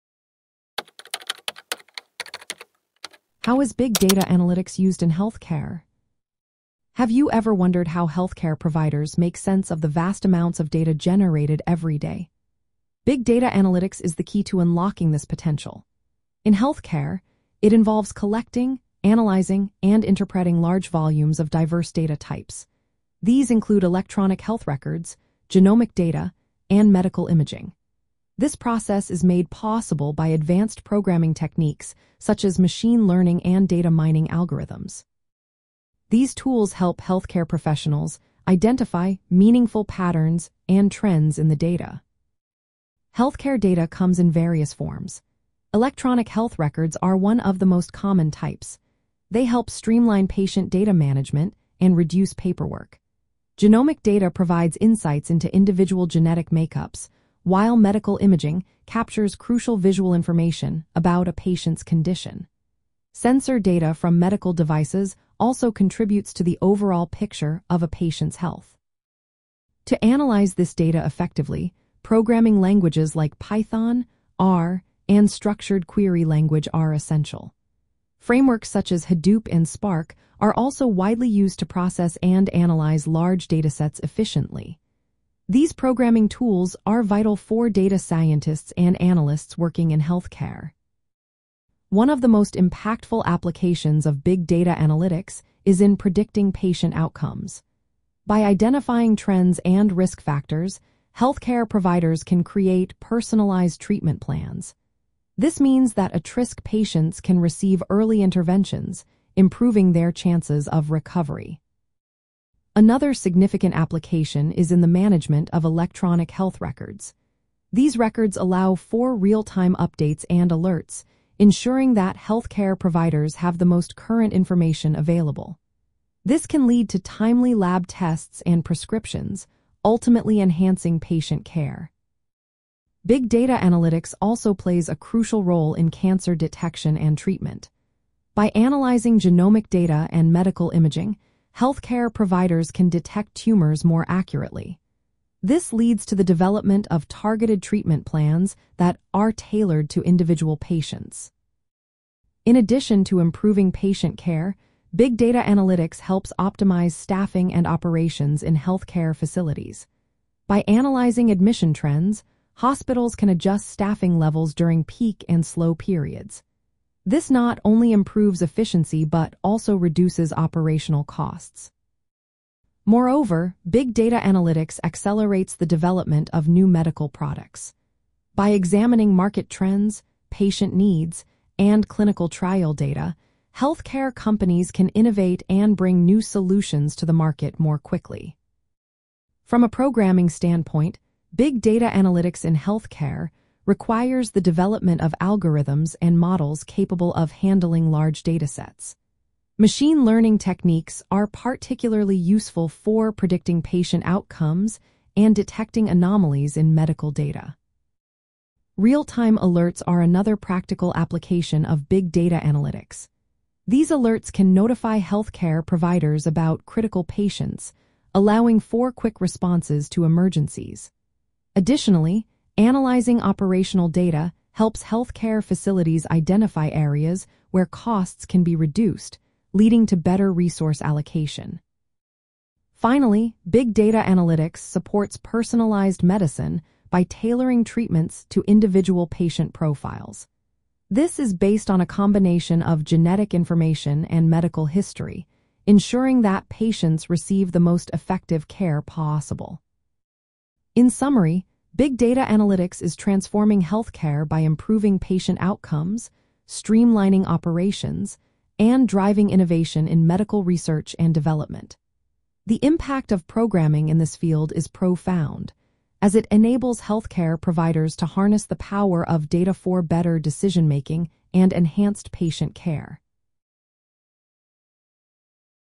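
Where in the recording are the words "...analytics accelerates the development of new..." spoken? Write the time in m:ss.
2:54.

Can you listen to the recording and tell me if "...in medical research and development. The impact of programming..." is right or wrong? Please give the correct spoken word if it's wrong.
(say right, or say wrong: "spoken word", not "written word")
right.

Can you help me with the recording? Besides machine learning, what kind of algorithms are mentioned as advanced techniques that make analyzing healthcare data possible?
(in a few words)
data mining algorithms.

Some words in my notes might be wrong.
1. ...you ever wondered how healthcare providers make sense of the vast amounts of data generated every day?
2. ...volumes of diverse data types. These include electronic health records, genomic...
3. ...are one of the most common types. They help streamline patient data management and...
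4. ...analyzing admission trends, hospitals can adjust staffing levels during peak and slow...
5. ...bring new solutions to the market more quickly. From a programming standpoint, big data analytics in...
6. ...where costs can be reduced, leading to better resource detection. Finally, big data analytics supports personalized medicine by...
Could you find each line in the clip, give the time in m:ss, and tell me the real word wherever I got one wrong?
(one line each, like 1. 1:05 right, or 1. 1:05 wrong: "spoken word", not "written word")
1. 0:07 right
2. 0:20 right
3. 0:46 right
4. 2:40 right
5. 3:05 right
6. 3:47 wrong: "allocation", not "detection".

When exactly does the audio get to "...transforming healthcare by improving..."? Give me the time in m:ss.
4:12.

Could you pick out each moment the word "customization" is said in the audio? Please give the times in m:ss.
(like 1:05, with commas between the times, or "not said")
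not said.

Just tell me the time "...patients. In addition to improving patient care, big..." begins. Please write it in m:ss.
2:30.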